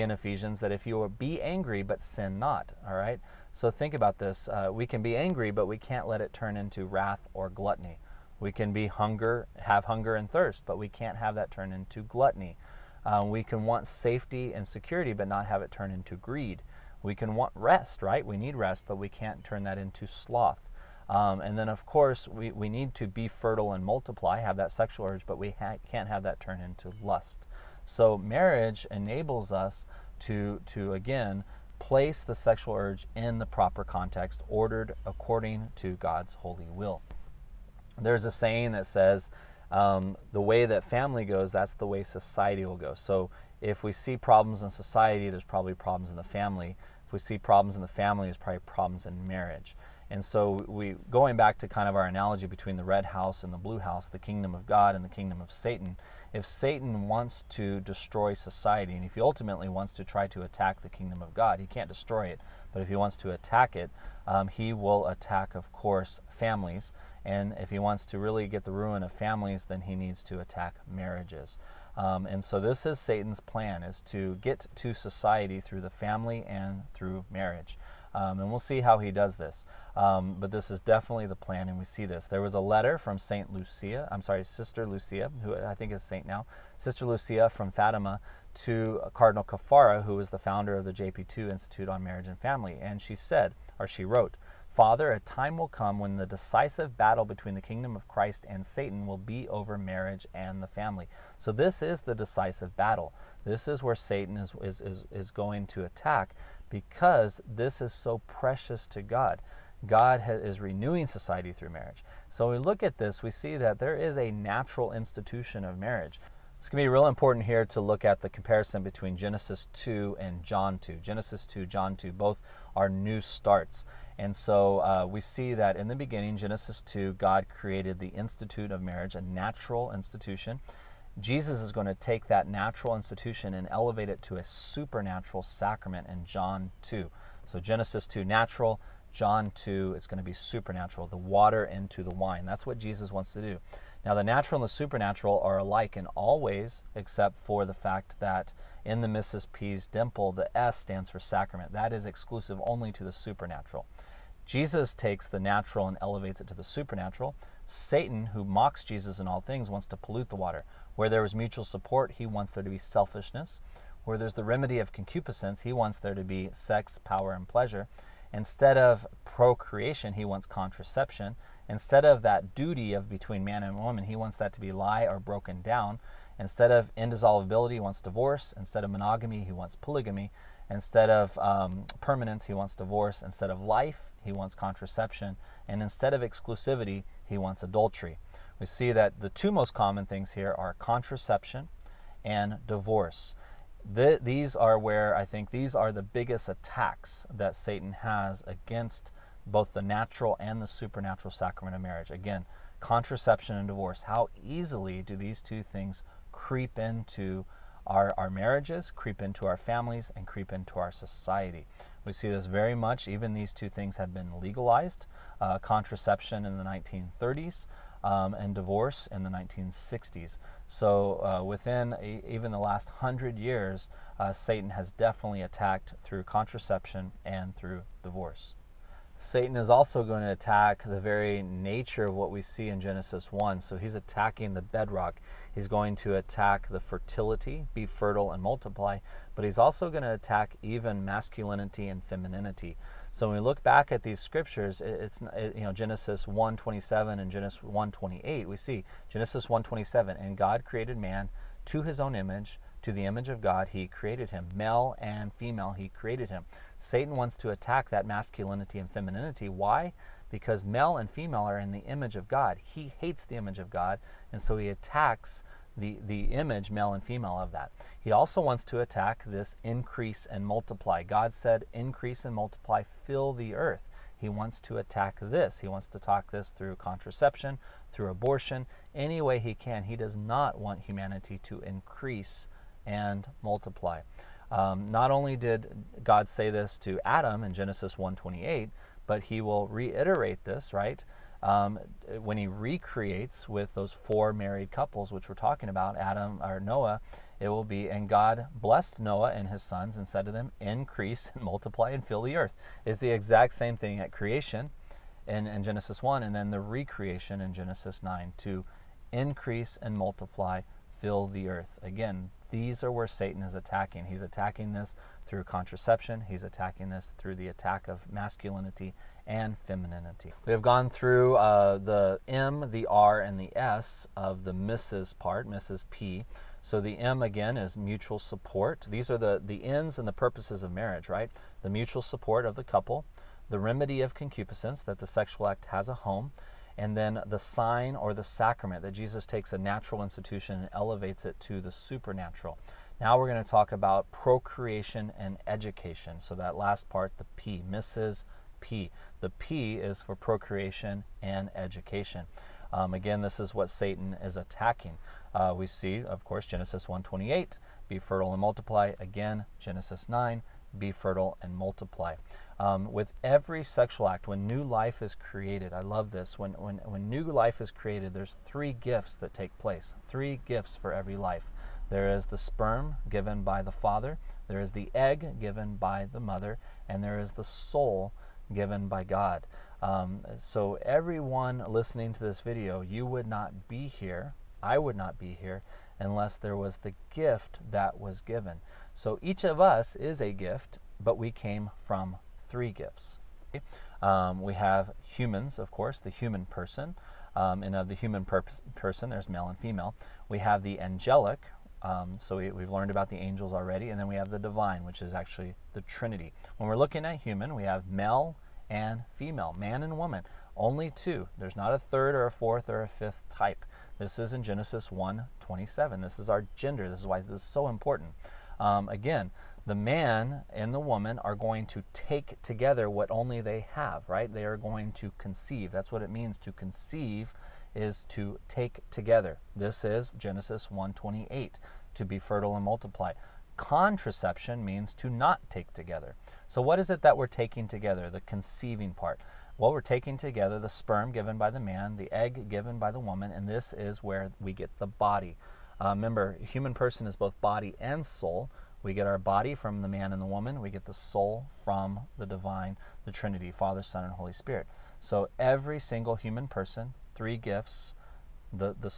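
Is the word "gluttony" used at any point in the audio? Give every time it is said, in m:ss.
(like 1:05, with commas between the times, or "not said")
0:07, 0:12.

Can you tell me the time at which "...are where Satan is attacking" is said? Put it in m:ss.
5:12.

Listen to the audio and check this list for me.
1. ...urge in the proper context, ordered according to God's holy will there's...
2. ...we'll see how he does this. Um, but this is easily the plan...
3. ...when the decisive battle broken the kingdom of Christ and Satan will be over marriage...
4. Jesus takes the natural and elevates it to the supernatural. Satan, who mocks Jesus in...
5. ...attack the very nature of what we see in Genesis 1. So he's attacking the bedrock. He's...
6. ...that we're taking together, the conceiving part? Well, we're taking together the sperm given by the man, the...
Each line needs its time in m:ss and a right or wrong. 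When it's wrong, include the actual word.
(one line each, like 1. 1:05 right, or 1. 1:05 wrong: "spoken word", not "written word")
1. 0:32 right
2. 1:18 wrong: "definitely", not "easily"
3. 1:35 wrong: "between", not "broken"
4. 2:34 right
5. 3:50 right
6. 7:17 right.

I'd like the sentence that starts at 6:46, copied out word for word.
When we're looking at human, we have male and female, man and woman, only two.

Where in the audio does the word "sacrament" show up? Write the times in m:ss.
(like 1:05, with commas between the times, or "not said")
2:15, 2:31, 3:21, 5:38.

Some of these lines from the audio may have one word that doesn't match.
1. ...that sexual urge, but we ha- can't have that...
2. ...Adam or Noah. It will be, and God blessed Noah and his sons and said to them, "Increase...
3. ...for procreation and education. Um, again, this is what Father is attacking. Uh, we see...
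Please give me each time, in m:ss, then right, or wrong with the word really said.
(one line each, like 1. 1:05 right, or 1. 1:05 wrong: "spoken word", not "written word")
1. 0:24 right
2. 4:55 right
3. 5:50 wrong: "Satan", not "Father".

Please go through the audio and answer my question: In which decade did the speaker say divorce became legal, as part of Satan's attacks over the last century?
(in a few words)
1960s.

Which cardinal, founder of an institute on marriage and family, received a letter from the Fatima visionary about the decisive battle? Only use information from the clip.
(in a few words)
Cardinal Caffarra.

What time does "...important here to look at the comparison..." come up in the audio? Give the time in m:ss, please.
1:57.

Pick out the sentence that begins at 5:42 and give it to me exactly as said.
Now we're going to talk about procreation and education.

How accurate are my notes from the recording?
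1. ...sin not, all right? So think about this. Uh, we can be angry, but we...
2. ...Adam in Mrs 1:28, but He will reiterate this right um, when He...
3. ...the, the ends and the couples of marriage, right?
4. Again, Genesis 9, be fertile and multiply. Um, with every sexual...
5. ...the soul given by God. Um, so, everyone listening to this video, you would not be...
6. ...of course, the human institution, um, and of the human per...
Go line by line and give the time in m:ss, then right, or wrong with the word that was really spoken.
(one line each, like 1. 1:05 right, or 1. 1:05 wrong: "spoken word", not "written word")
1. 0:02 right
2. 4:47 wrong: "Genesis", not "Mrs"
3. 5:29 wrong: "purposes", not "couples"
4. 5:58 right
5. 6:17 right
6. 6:35 wrong: "person", not "institution".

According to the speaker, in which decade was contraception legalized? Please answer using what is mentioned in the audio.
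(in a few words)
1930s.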